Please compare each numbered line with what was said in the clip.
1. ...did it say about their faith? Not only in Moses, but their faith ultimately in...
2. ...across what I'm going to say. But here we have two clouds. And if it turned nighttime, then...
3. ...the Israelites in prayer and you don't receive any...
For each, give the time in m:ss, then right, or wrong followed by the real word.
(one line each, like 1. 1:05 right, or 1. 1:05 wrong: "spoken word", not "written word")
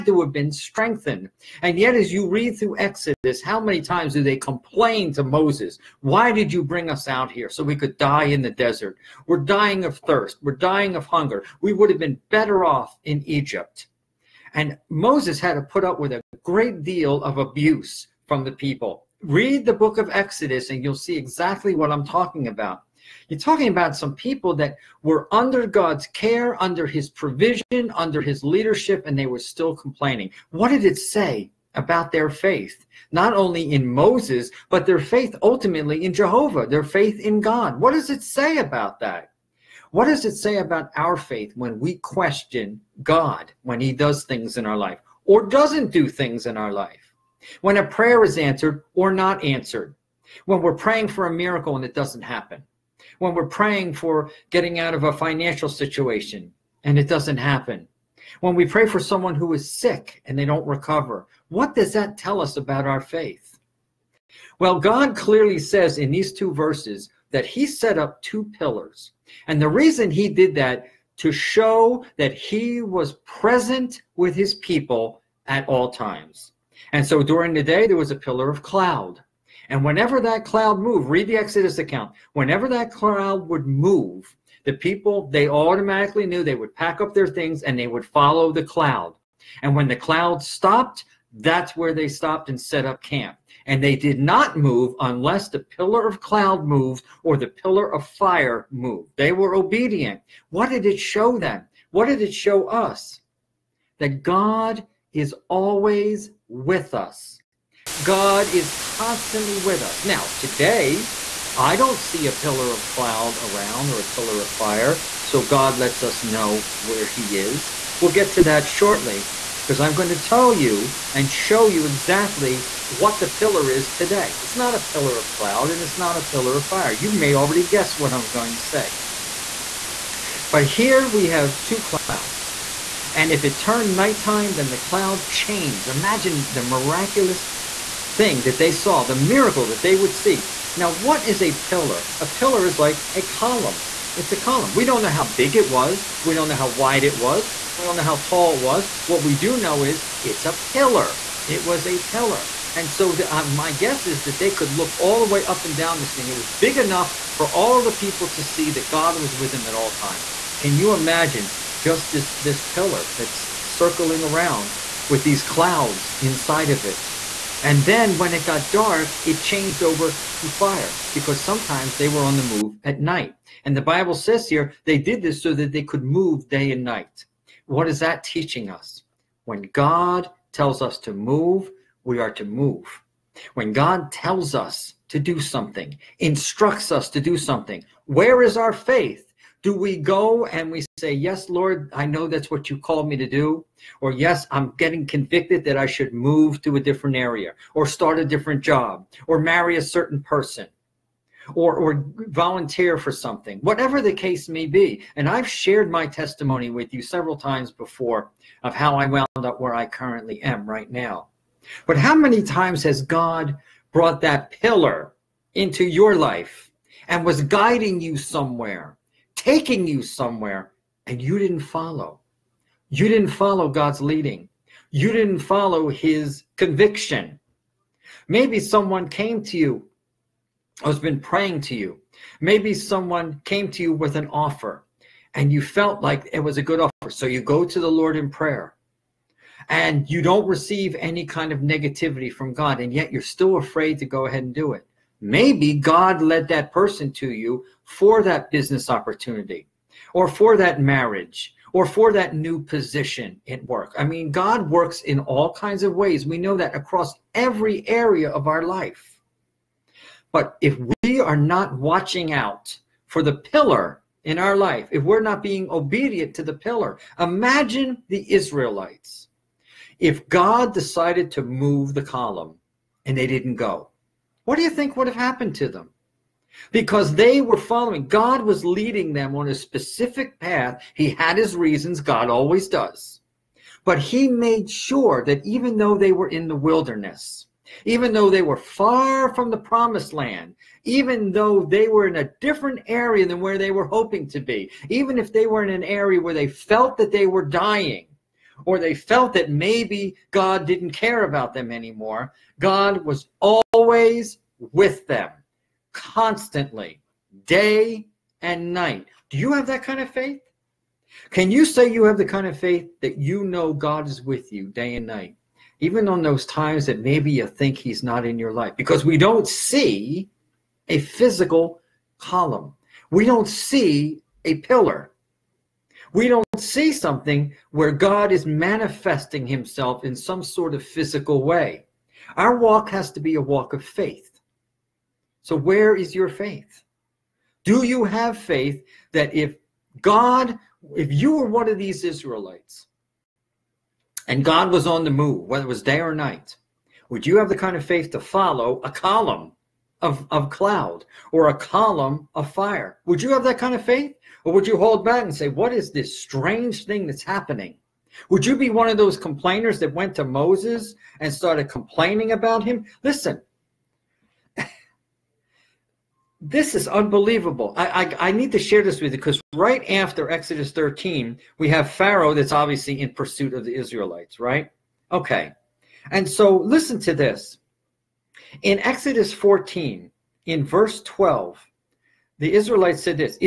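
1. 0:30 right
2. 2:07 wrong: "guess", not "across"
3. 3:57 wrong: "Lord", not "Israelites".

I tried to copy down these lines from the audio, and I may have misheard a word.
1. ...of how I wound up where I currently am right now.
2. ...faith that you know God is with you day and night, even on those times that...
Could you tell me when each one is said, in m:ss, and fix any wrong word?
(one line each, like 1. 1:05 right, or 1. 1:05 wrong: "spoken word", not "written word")
1. 3:28 right
2. 5:12 right.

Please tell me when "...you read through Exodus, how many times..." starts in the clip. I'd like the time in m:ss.
0:02.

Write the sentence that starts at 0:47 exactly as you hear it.
When a prayer is answered or not answered?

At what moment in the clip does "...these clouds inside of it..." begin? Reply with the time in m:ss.
2:45.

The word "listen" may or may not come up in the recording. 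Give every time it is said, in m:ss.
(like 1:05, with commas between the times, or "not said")
6:03, 6:16.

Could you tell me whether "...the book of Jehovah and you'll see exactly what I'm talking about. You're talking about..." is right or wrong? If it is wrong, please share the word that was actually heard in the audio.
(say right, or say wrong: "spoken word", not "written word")
wrong: "Exodus", not "Jehovah".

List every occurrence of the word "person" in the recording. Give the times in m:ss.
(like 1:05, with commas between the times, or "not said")
3:20, 4:06.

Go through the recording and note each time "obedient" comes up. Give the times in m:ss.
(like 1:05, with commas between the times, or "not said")
1:39, 4:25.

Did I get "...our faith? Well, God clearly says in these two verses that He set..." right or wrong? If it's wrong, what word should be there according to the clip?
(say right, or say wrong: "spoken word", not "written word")
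right.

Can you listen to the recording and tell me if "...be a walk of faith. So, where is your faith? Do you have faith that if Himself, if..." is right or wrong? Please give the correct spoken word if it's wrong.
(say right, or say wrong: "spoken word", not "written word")
wrong: "God", not "Himself".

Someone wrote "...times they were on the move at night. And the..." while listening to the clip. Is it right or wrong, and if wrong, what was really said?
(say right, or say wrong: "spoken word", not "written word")
wrong: "sometimes", not "times".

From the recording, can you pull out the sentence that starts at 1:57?
We'll get to that shortly because I'm going to tell you and show you exactly what the pillar is today.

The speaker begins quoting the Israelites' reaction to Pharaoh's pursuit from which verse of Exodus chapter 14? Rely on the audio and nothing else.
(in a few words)
12.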